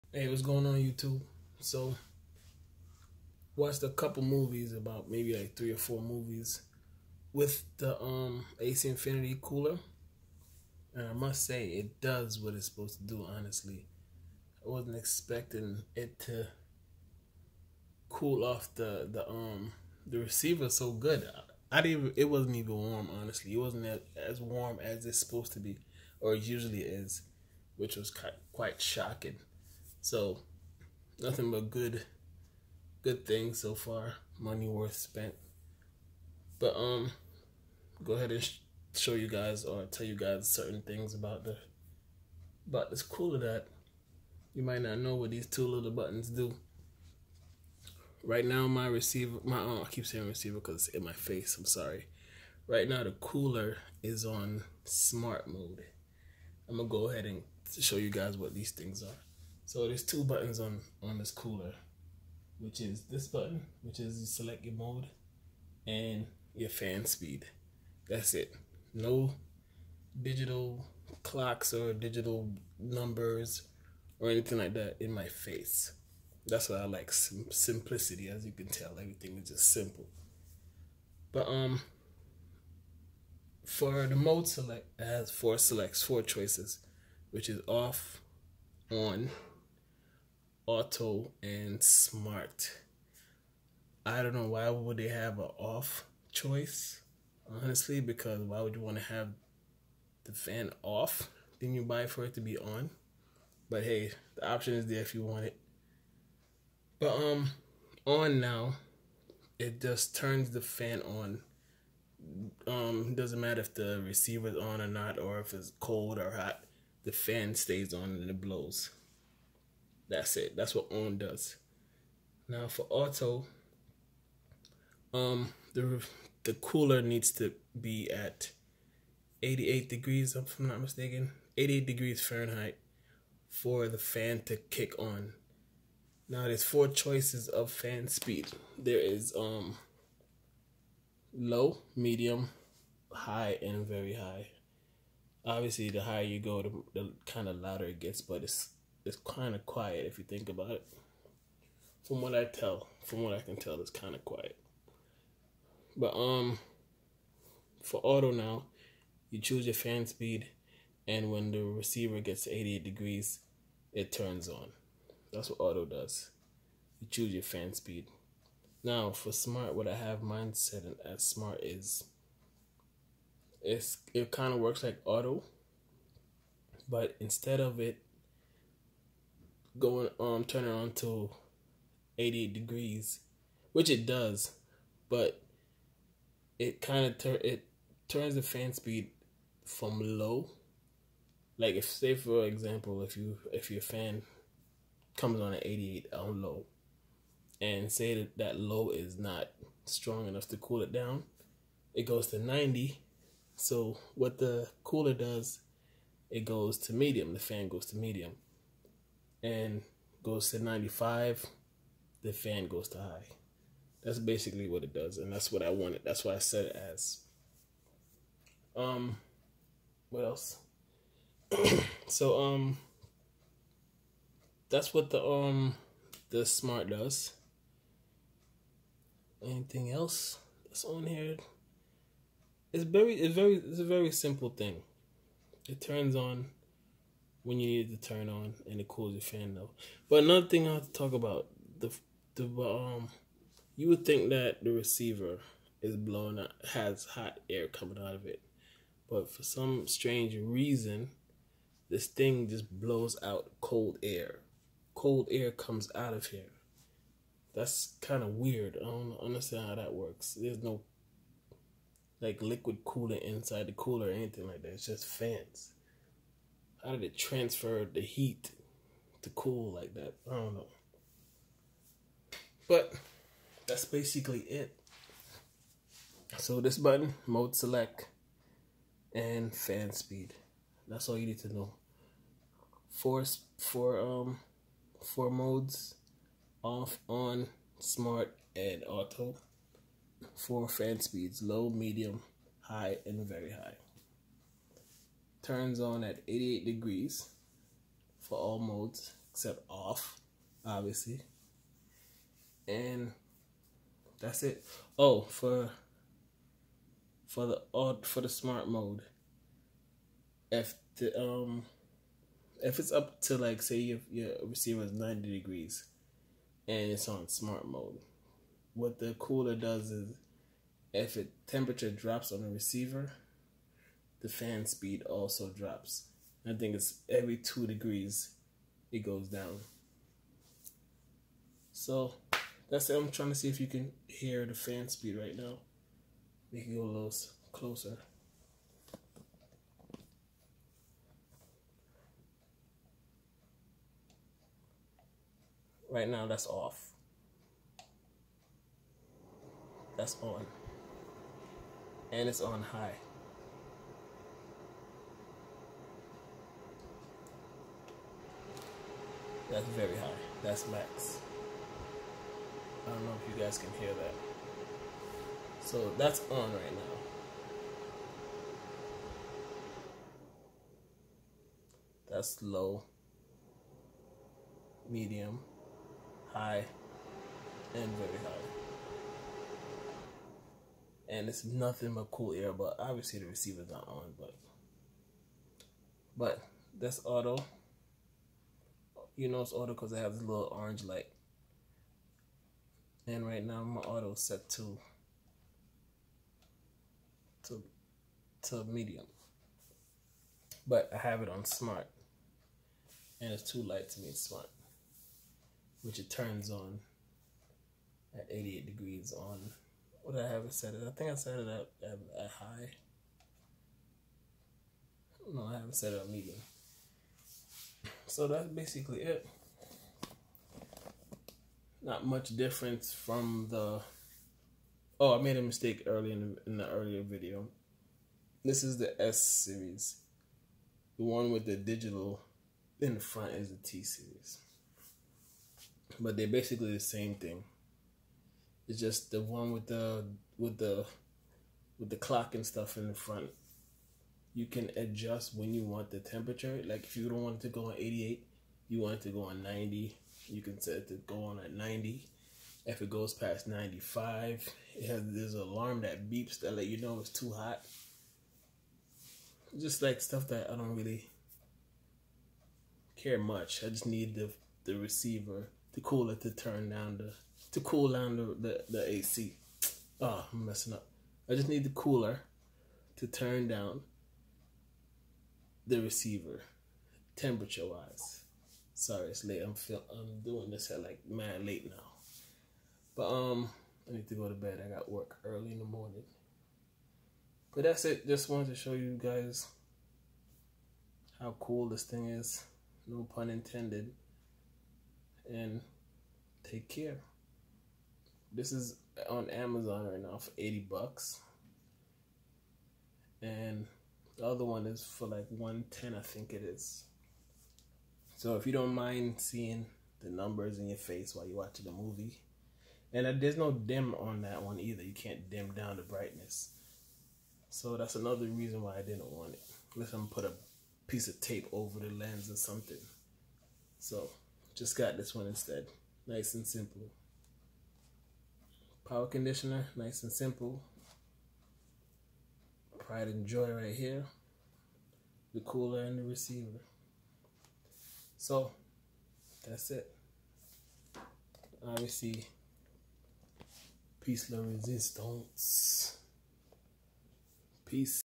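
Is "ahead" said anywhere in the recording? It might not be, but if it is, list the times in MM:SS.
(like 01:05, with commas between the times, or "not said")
00:38, 00:57.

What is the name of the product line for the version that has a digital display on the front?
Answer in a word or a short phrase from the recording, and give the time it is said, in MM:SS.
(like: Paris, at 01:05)
T series, at 07:13.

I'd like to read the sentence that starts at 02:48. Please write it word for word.
Now for smart, what I have mine set as smart is.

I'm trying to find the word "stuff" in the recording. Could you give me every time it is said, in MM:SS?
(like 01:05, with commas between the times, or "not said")
07:22, 07:39.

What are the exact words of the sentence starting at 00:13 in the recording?
Honestly, I wasn't expecting it to cool off the the um the receiver so good.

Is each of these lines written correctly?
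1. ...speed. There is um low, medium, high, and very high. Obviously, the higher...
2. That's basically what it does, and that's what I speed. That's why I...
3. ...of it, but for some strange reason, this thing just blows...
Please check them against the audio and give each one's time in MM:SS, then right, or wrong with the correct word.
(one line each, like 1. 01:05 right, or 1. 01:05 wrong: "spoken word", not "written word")
1. 02:18 right
2. 03:34 wrong: "wanted", not "speed"
3. 04:08 right.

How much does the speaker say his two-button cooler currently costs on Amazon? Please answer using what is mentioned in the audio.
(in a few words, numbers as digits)
80 bucks.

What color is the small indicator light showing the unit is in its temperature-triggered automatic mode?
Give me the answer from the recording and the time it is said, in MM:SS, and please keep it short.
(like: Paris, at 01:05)
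orange, at 06:30.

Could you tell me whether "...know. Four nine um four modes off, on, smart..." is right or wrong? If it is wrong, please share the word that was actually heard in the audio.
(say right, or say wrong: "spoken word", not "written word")
wrong: "four", not "nine".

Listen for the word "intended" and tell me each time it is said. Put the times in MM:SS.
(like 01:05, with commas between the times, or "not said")
08:13.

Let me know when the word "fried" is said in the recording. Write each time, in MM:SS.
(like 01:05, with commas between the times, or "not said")
not said.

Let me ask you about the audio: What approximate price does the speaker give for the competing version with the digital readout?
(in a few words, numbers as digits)
110.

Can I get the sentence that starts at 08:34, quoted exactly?
You can't dim down the brightness.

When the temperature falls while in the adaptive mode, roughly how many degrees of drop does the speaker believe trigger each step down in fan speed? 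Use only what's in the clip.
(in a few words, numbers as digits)
2.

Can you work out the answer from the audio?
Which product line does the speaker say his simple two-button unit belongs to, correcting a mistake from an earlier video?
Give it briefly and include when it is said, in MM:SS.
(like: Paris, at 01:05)
S series, at 07:09.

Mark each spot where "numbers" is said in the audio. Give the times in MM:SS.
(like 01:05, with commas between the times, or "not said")
01:12, 08:30.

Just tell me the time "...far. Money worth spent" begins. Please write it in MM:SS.
00:33.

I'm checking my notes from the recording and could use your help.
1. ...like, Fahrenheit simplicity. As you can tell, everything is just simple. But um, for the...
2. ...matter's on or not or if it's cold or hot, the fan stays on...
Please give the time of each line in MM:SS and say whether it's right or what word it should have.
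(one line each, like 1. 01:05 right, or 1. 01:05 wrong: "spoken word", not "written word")
1. 01:16 wrong: "Sim", not "Fahrenheit"
2. 01:54 wrong: "receiver", not "matter".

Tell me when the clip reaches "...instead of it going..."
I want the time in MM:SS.
02:57.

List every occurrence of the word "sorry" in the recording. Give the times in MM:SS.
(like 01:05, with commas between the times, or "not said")
00:51, 07:58.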